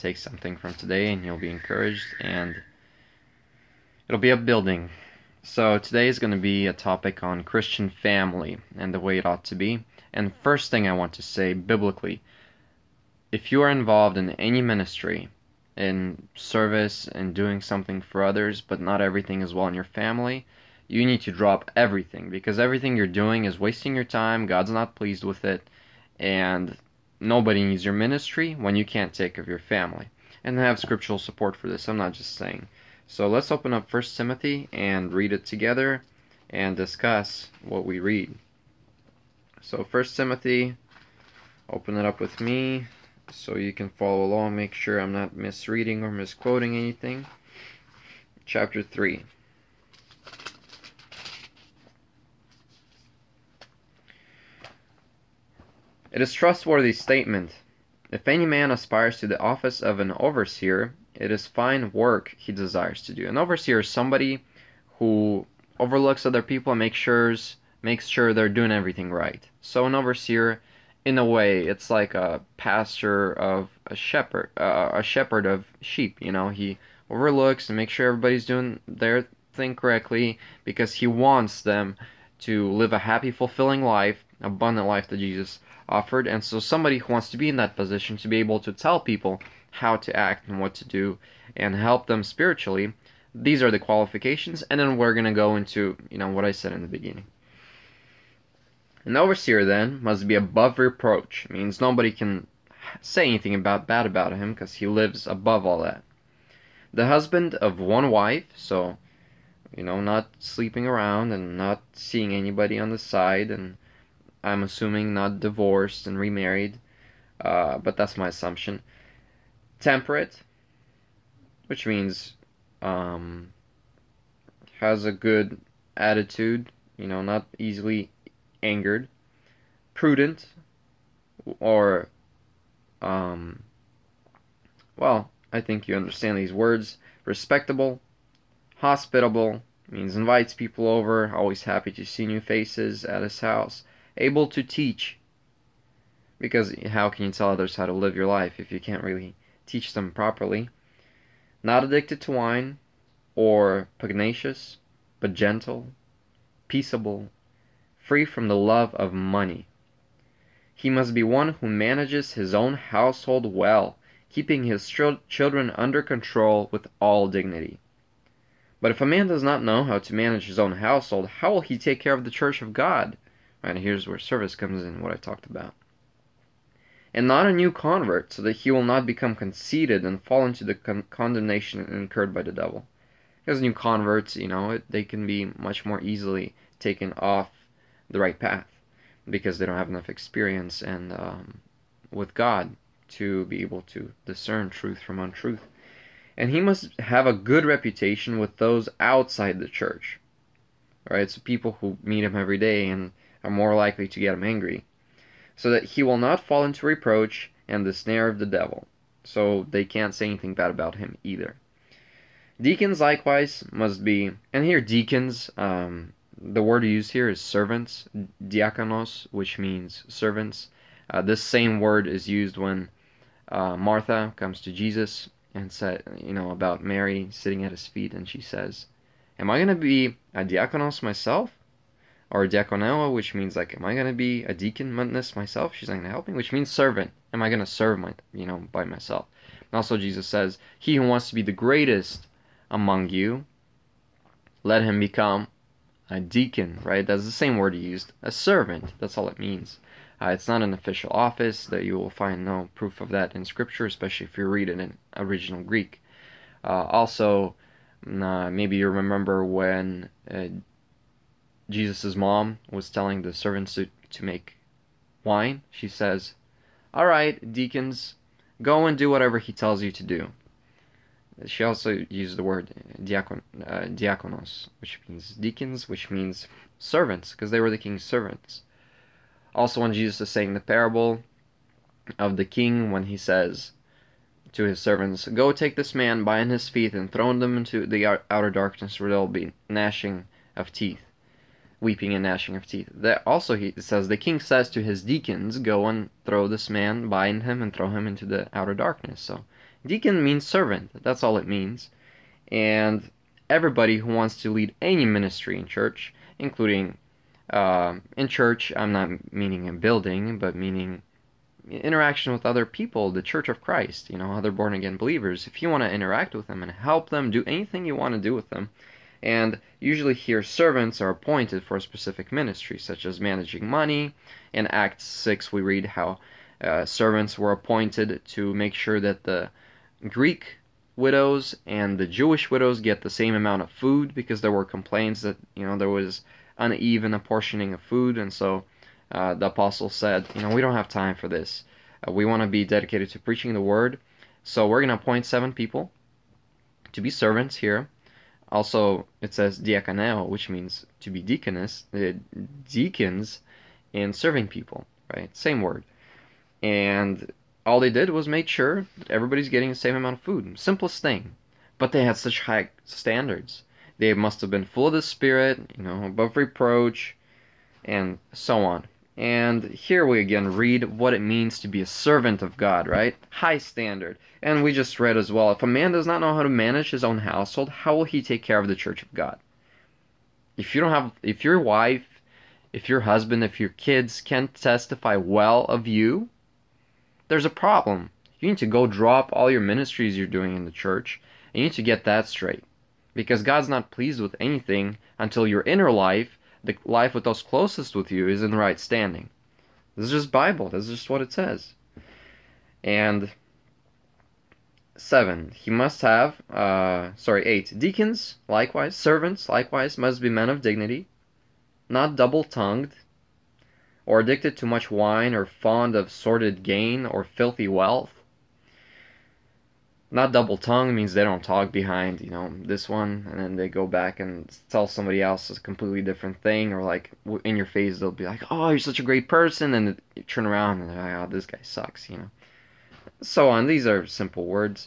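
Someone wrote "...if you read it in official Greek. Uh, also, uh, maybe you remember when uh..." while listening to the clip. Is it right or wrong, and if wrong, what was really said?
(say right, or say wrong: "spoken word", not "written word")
wrong: "original", not "official".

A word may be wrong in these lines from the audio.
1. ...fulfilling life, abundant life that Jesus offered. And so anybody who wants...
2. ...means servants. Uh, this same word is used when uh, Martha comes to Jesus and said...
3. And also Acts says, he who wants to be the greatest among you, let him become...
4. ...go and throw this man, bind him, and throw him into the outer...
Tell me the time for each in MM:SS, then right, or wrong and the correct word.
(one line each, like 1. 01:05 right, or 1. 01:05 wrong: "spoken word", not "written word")
1. 01:23 wrong: "somebody", not "anybody"
2. 03:39 right
3. 03:59 wrong: "Jesus", not "Acts"
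4. 04:55 right.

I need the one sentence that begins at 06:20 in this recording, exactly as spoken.
If you don't have, if your wife, if your husband, if your kids can't testify well of you, there's a problem.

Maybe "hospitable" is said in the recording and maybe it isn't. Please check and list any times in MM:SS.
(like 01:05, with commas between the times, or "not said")
02:18.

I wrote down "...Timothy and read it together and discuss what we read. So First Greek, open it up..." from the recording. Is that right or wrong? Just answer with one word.
wrong.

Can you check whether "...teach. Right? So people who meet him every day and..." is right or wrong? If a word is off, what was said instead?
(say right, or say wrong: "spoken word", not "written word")
wrong: "church", not "teach".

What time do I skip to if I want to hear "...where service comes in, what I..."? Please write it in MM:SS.
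02:54.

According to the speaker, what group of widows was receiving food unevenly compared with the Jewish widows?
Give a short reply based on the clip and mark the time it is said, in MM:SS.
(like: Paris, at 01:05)
Greek widows, at 05:30.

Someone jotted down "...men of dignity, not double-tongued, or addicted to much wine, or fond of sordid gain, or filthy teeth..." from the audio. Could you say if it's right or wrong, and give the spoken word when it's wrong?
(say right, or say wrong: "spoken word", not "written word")
wrong: "wealth", not "teeth".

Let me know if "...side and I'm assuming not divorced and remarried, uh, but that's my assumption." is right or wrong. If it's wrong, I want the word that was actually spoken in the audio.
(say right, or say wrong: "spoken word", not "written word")
right.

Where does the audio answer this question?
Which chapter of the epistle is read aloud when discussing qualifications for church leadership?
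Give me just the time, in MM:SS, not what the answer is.
00:48.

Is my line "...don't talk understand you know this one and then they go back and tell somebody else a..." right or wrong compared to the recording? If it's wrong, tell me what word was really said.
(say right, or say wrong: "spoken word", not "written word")
wrong: "behind", not "understand".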